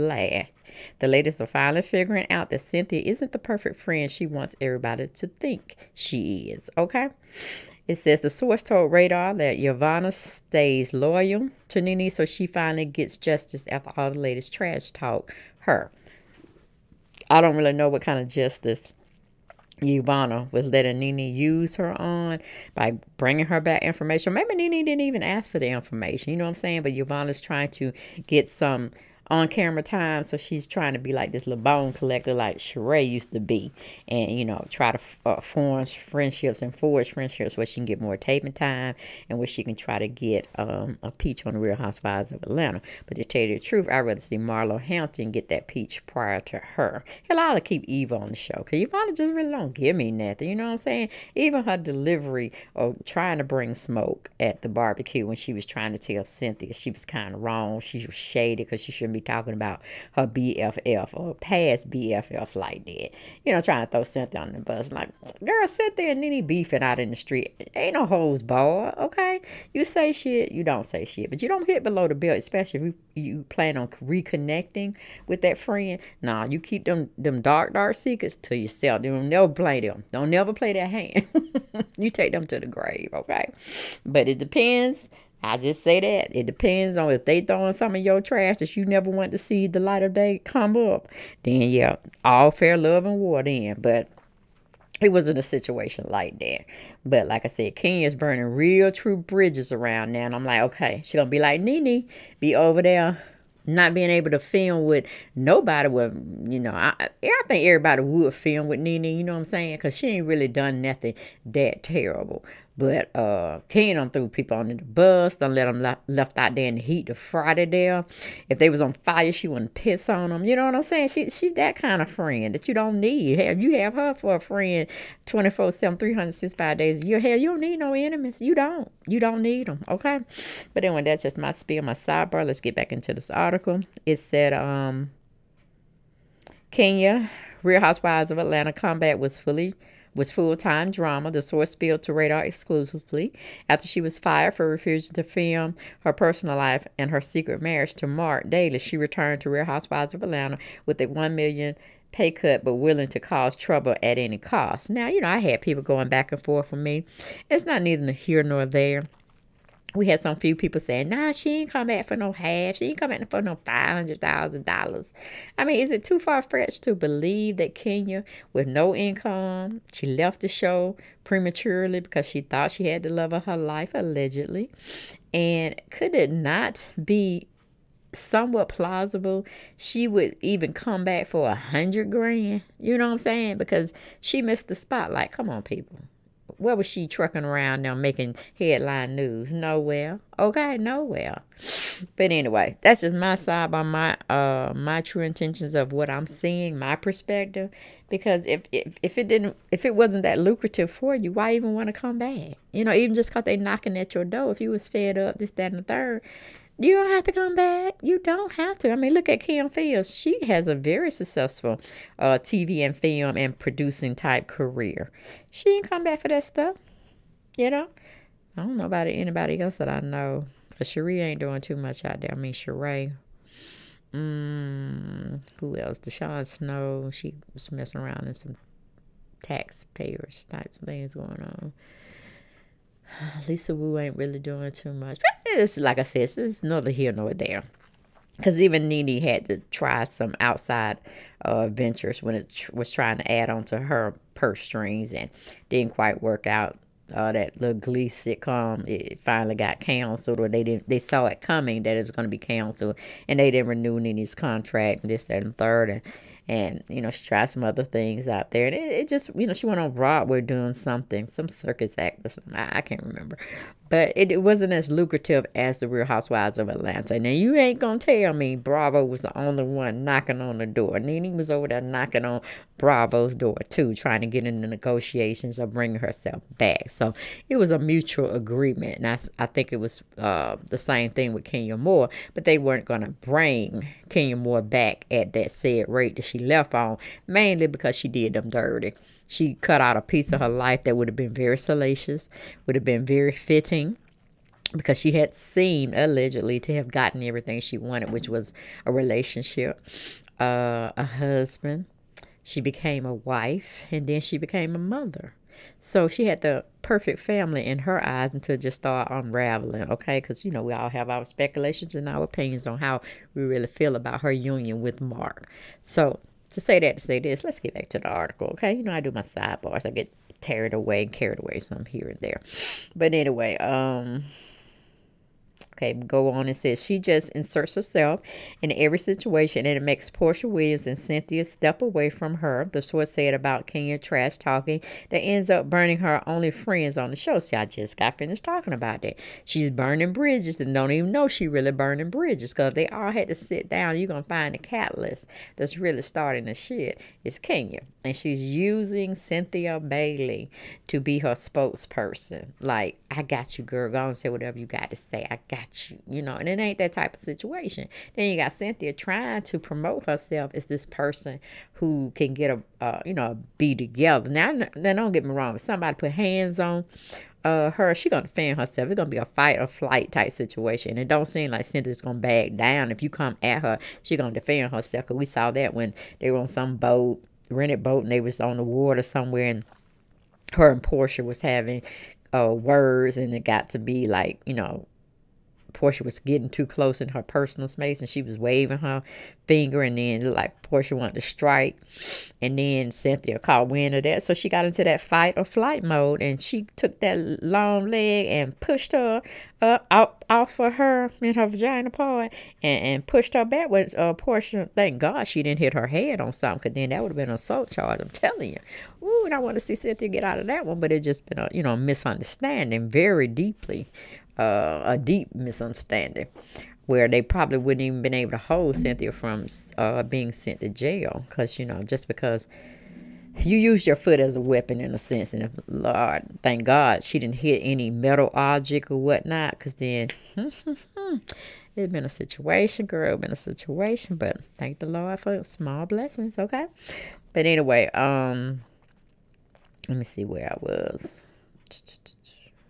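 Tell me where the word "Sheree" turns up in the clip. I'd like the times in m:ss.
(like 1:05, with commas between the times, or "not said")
0:32, 3:42.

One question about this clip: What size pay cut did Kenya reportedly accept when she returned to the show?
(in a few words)
$1 million.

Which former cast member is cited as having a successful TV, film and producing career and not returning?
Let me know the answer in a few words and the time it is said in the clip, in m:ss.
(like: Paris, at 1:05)
Kim Fields, at 3:29.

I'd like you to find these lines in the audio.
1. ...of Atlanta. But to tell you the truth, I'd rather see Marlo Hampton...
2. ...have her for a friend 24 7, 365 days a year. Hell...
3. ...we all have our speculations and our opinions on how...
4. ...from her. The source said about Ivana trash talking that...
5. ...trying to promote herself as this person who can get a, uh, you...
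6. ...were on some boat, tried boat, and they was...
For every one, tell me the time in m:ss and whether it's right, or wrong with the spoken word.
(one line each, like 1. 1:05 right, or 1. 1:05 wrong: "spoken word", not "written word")
1. 0:42 right
2. 2:03 right
3. 5:10 right
4. 5:32 wrong: "Kenya", not "Ivana"
5. 5:58 right
6. 6:16 wrong: "rented", not "tried".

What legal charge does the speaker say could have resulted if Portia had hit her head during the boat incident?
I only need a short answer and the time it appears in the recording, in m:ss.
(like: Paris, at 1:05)
assault charge, at 6:47.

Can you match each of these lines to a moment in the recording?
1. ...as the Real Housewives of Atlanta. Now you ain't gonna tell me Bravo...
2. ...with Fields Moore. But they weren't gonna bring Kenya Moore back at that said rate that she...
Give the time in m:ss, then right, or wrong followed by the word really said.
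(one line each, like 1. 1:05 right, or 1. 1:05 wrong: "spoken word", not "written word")
1. 4:25 right
2. 4:41 wrong: "Kenya", not "Fields".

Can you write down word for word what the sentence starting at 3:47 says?
She was messing around in some taxpayers type things going on.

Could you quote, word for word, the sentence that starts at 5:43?
You're going to find the catalyst that's really starting the shit is Kenya.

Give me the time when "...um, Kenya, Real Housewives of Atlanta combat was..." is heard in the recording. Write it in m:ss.
2:14.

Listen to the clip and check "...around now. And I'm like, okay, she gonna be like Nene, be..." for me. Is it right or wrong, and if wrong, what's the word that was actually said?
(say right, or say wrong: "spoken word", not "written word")
right.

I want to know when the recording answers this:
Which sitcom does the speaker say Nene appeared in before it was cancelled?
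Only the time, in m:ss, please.
4:07.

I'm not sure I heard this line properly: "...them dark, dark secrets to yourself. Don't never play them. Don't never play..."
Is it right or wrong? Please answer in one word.
right.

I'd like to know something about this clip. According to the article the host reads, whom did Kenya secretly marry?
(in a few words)
Mark Daly.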